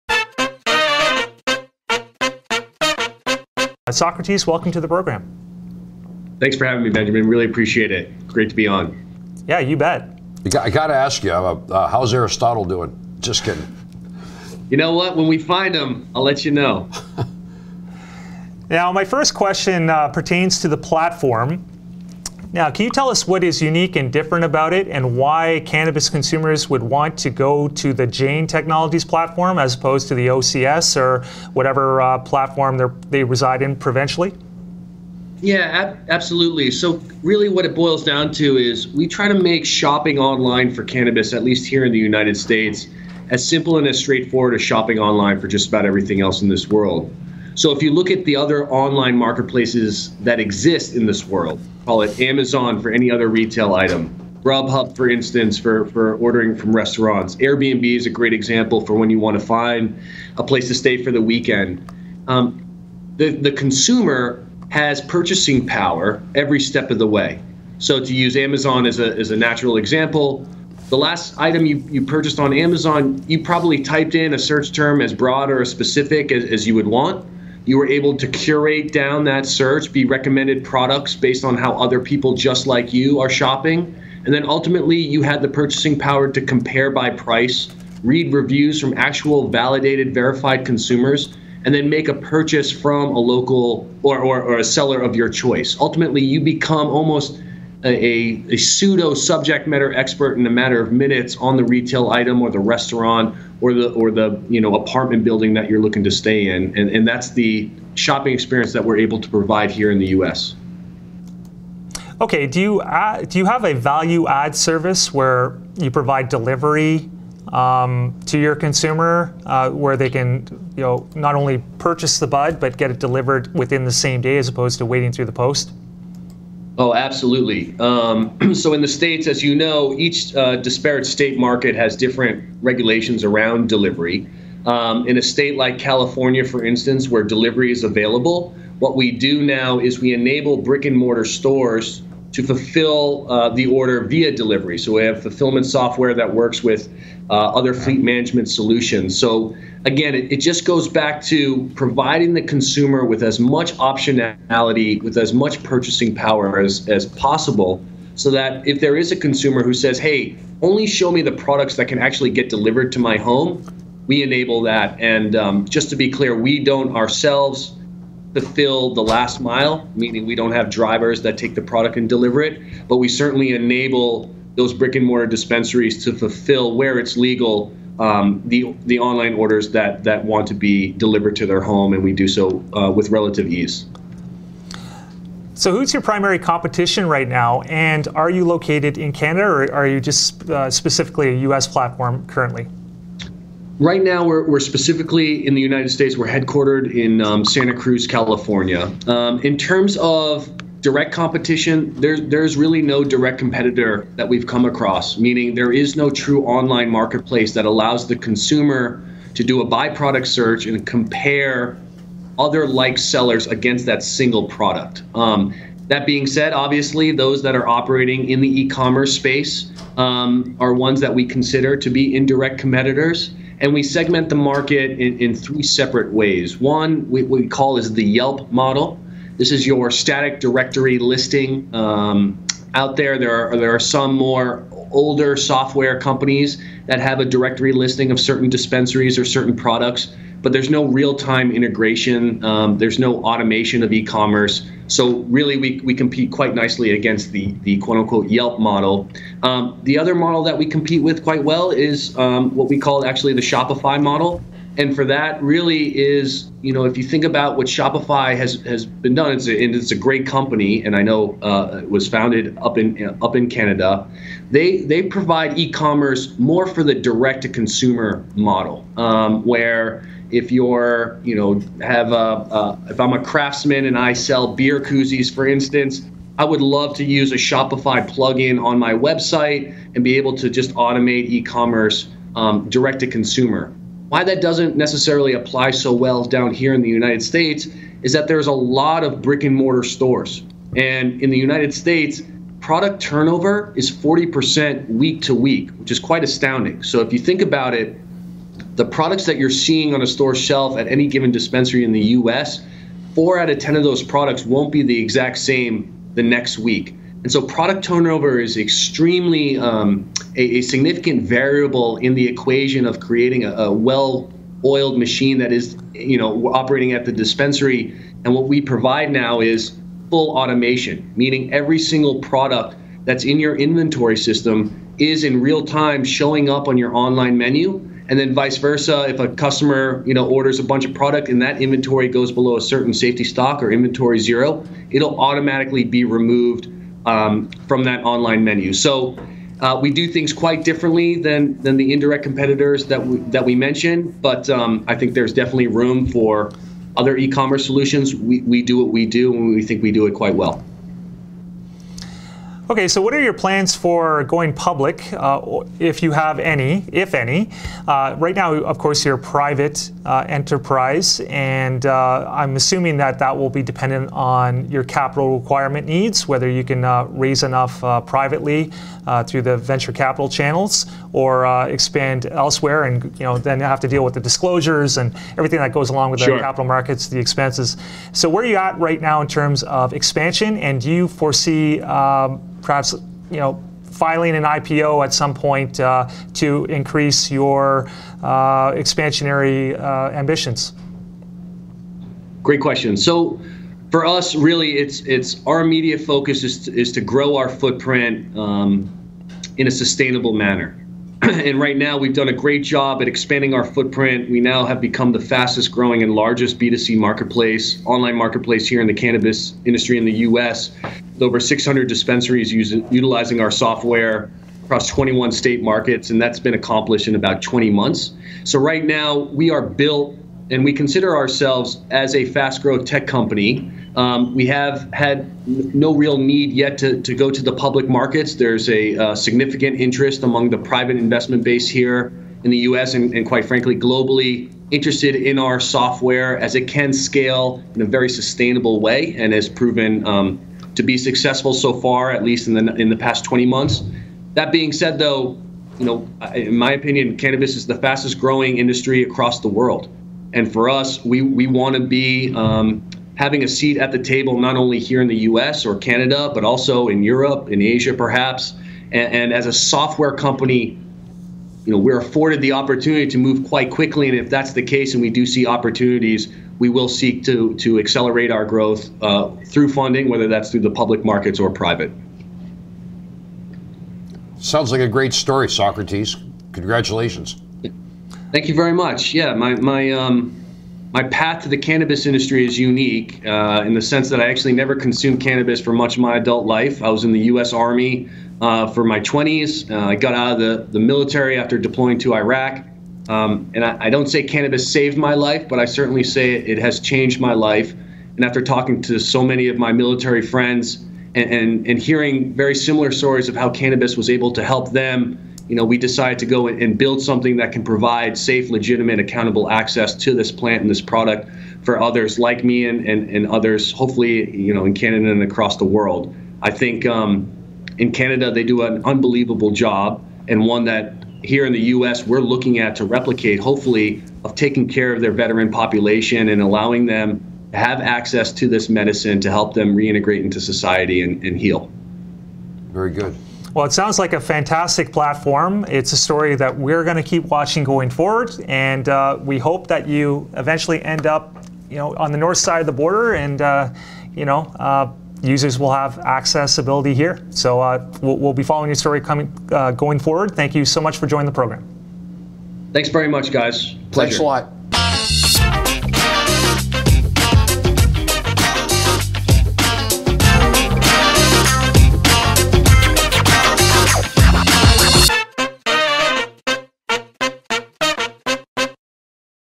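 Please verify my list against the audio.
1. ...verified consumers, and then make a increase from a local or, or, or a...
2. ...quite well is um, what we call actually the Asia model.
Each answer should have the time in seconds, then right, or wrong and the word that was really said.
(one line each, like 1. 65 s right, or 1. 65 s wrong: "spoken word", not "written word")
1. 90 s wrong: "purchase", not "increase"
2. 251 s wrong: "Shopify", not "Asia".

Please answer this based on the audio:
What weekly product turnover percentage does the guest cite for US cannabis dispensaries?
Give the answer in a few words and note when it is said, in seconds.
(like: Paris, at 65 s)
40%, at 293 s.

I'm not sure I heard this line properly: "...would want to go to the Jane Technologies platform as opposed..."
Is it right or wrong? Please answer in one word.
right.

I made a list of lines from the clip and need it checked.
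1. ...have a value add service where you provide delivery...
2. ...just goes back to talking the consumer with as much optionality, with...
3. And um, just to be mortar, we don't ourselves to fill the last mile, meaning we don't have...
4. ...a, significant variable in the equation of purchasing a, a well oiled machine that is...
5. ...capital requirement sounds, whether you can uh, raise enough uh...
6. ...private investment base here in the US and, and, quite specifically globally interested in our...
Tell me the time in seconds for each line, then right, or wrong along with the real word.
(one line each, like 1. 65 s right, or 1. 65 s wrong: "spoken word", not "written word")
1. 113 s right
2. 150 s wrong: "providing", not "talking"
3. 164 s wrong: "clear", not "mortar"
4. 310 s wrong: "creating", not "purchasing"
5. 364 s wrong: "needs", not "sounds"
6. 430 s wrong: "frankly", not "specifically".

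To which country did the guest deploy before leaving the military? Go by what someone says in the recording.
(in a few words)
Iraq.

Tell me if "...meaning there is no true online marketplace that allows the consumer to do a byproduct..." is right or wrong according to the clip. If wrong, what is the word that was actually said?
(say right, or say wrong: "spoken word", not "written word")
right.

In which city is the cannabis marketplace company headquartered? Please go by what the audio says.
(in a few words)
Santa Cruz.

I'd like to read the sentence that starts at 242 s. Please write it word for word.
Um, there's no automation of e-commerce.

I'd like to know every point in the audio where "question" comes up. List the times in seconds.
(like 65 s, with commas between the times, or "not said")
19 s, 392 s.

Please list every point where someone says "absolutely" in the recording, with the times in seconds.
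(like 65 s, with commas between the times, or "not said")
36 s, 126 s.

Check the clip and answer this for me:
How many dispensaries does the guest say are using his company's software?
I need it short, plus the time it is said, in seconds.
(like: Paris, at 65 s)
600, at 411 s.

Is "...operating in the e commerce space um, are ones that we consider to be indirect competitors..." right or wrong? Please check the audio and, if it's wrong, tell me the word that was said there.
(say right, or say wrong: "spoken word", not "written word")
right.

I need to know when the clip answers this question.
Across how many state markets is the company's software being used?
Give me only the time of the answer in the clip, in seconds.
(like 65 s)
414 s.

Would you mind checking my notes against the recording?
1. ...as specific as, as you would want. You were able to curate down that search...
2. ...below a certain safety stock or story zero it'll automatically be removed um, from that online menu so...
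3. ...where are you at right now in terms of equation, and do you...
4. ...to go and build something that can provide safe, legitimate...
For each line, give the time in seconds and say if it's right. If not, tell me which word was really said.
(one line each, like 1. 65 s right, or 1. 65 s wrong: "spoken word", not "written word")
1. 75 s right
2. 332 s wrong: "inventory", not "story"
3. 378 s wrong: "expansion", not "equation"
4. 506 s right.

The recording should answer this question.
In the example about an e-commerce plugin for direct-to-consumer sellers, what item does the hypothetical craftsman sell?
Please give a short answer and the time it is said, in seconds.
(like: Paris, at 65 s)
Beer koozies, at 274 s.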